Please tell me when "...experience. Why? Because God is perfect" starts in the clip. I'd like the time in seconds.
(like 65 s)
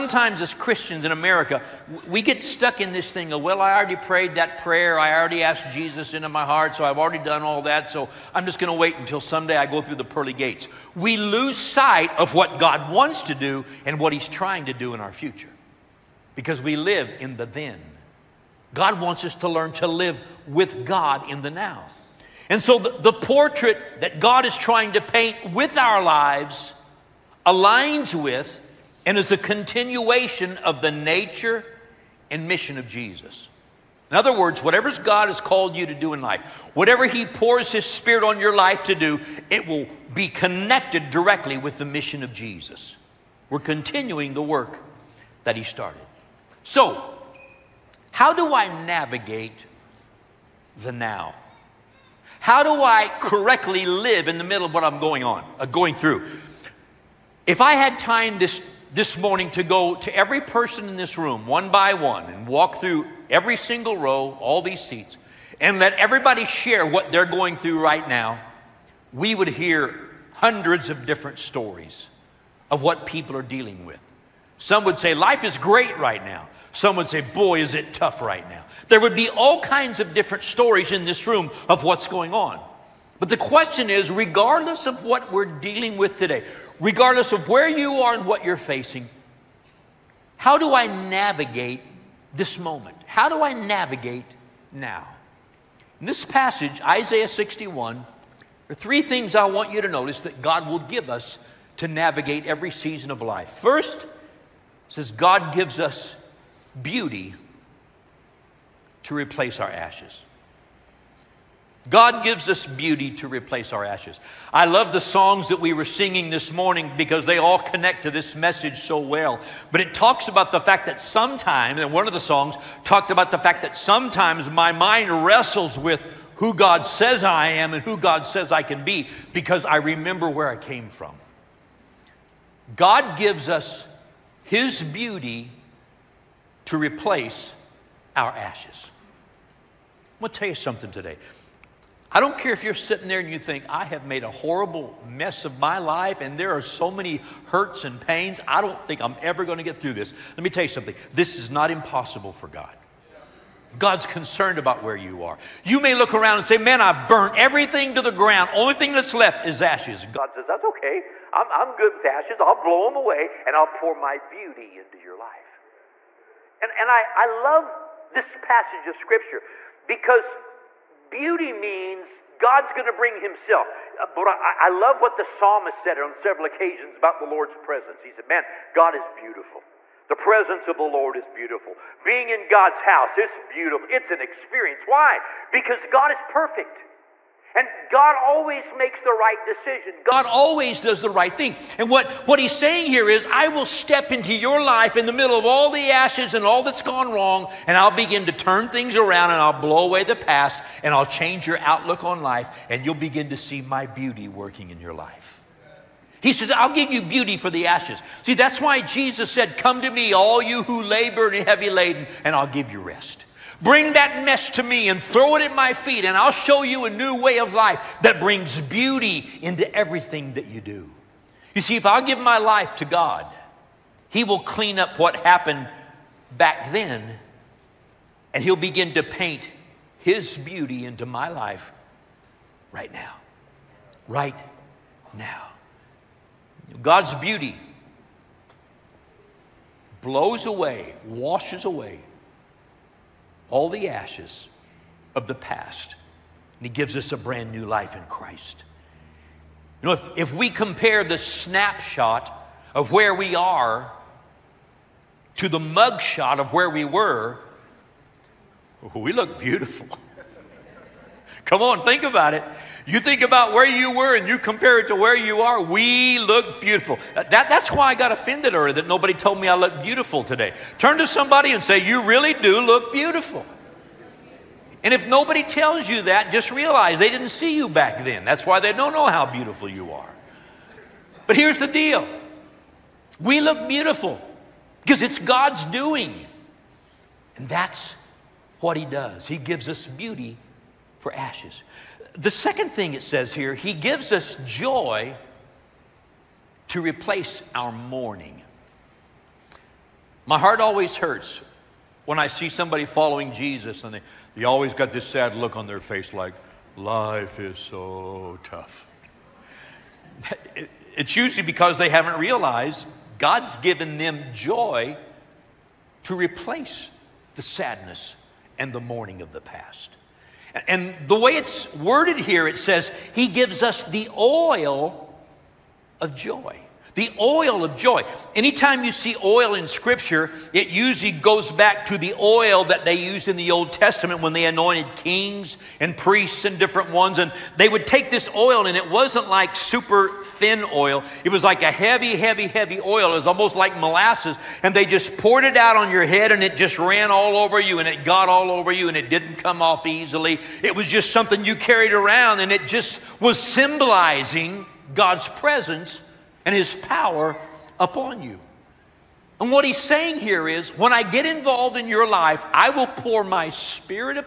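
184 s.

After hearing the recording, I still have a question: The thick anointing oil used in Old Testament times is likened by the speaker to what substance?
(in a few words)
molasses.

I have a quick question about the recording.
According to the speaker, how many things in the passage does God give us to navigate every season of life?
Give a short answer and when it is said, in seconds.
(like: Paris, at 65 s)
3, at 98 s.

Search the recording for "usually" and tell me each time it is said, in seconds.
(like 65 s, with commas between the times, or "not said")
311 s, 330 s.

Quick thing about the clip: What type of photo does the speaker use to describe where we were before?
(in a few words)
mugshot.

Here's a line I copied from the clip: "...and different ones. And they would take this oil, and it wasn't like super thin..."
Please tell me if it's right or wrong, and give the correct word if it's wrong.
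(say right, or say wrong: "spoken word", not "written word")
right.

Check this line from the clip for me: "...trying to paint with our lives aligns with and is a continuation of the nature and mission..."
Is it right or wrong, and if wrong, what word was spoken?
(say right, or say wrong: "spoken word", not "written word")
right.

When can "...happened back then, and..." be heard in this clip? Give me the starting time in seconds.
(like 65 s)
225 s.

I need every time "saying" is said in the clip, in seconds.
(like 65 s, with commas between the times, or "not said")
192 s, 359 s.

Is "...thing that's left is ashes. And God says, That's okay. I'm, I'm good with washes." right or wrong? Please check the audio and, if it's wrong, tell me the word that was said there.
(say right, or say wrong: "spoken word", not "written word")
wrong: "ashes", not "washes".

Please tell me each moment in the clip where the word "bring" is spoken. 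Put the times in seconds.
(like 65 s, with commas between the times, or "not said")
172 s, 213 s, 218 s.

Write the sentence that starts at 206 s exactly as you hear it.
He says, I'll give you beauty for the ashes.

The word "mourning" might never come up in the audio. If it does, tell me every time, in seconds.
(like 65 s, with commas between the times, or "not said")
297 s, 318 s.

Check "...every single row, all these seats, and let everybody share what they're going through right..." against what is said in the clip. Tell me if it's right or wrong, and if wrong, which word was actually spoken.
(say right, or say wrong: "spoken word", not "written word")
right.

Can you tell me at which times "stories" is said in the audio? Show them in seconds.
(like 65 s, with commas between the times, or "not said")
71 s, 80 s.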